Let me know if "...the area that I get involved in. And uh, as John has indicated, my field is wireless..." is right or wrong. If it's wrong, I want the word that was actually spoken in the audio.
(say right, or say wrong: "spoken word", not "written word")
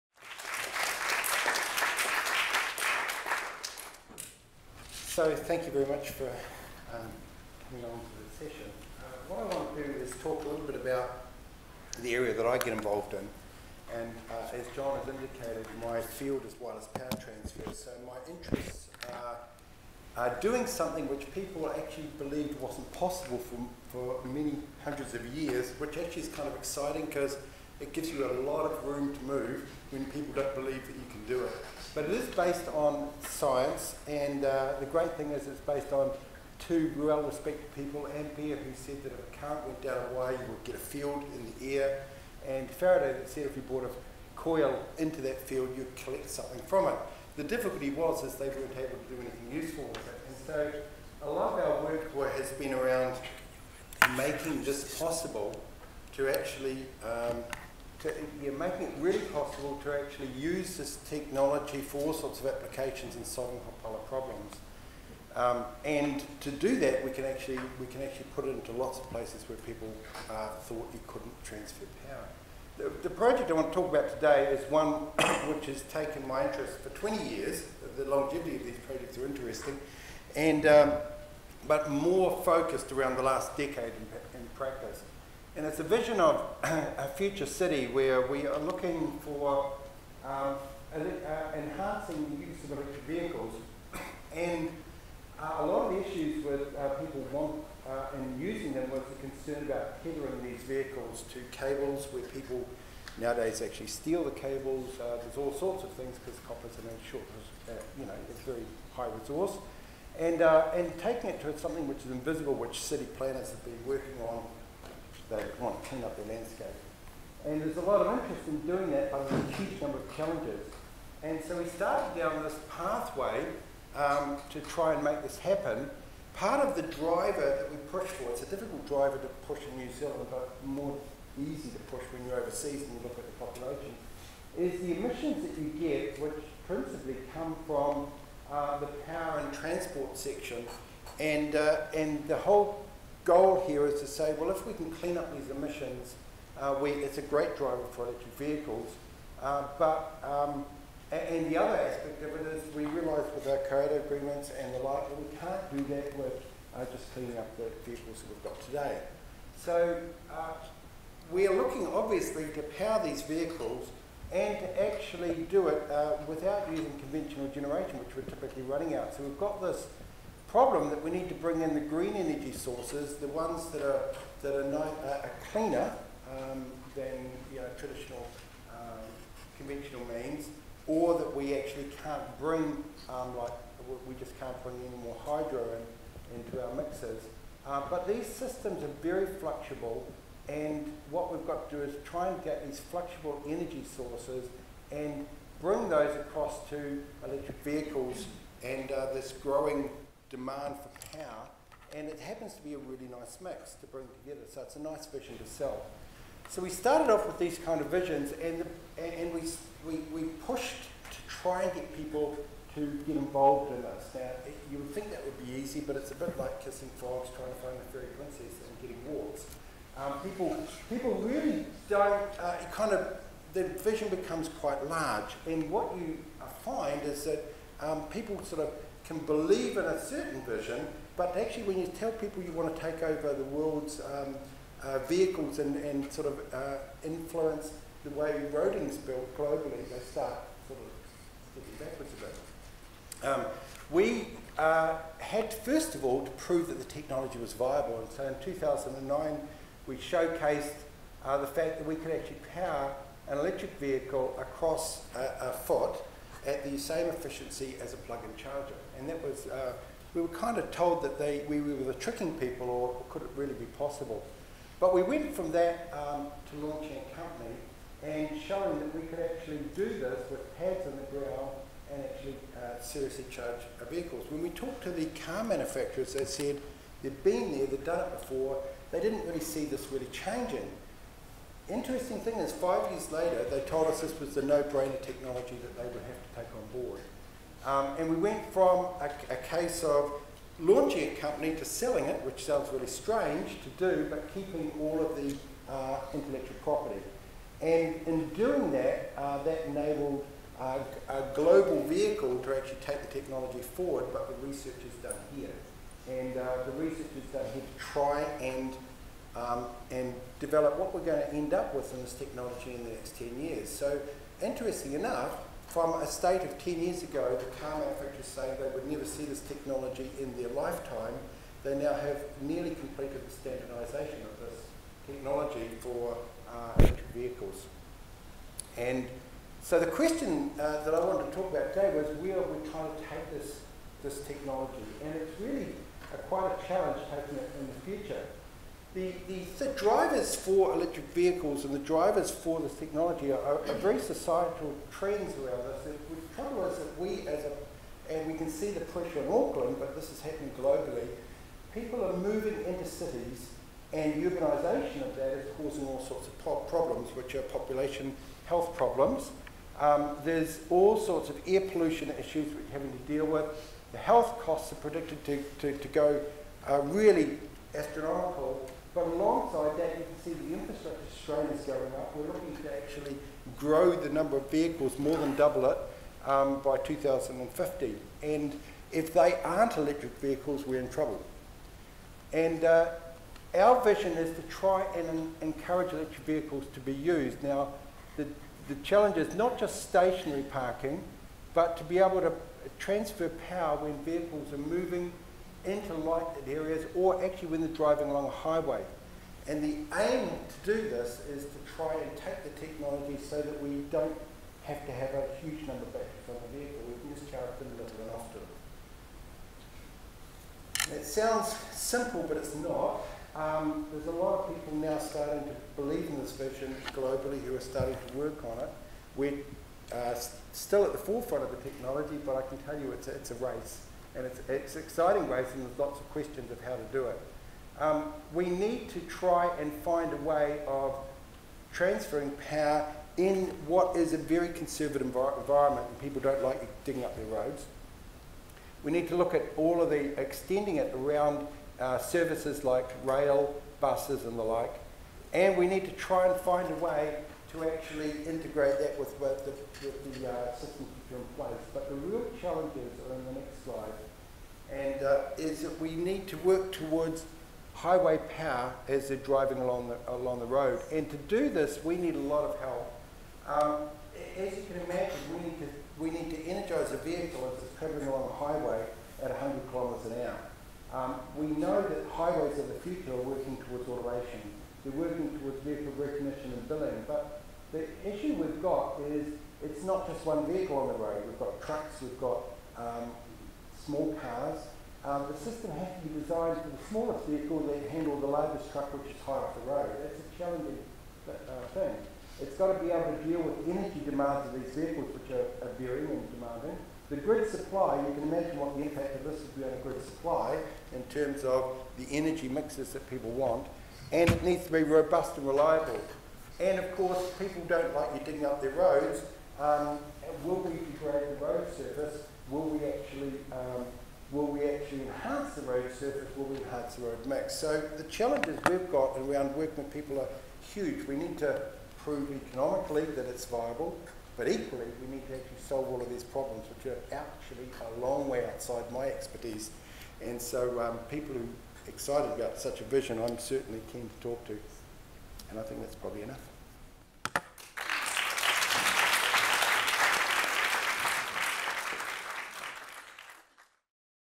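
right.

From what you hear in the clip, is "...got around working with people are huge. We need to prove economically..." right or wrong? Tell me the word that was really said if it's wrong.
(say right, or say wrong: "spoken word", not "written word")
right.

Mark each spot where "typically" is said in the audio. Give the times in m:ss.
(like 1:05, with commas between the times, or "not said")
2:48.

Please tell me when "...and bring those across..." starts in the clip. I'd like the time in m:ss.
3:14.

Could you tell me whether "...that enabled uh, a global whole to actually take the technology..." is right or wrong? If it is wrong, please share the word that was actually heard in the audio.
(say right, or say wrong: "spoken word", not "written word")
wrong: "vehicle", not "whole".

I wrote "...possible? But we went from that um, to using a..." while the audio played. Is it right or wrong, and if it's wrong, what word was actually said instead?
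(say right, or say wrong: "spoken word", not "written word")
wrong: "launching", not "using".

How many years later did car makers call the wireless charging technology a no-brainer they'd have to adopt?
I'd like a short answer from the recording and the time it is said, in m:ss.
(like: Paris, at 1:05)
5 years, at 4:42.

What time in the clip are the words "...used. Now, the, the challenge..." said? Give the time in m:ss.
6:26.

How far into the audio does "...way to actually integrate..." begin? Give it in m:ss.
7:26.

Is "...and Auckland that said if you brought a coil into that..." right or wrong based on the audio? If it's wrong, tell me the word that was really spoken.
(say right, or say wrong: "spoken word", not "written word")
wrong: "Faraday", not "Auckland".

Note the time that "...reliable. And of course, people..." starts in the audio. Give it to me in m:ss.
8:25.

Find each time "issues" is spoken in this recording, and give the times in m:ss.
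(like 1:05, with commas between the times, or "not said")
1:36, 6:02, 7:58.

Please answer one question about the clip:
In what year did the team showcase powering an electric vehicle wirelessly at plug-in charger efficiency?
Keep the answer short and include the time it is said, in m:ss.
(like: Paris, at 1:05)
2009, at 4:08.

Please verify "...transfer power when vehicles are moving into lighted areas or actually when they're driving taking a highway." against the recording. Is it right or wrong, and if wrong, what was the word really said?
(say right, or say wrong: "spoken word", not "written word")
wrong: "along", not "taking".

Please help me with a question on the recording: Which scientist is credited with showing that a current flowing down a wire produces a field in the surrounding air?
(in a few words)
Ampere.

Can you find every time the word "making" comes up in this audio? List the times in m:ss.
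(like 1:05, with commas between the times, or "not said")
0:54, 0:58.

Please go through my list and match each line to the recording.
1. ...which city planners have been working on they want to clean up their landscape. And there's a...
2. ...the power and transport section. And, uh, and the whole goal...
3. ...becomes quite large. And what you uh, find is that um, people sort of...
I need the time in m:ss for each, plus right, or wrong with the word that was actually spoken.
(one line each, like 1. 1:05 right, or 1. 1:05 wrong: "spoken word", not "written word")
1. 1:52 right
2. 2:18 right
3. 3:44 right.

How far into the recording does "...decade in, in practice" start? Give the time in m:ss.
1:23.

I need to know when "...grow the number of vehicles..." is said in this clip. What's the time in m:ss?
6:13.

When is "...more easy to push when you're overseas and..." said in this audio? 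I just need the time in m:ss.
2:10.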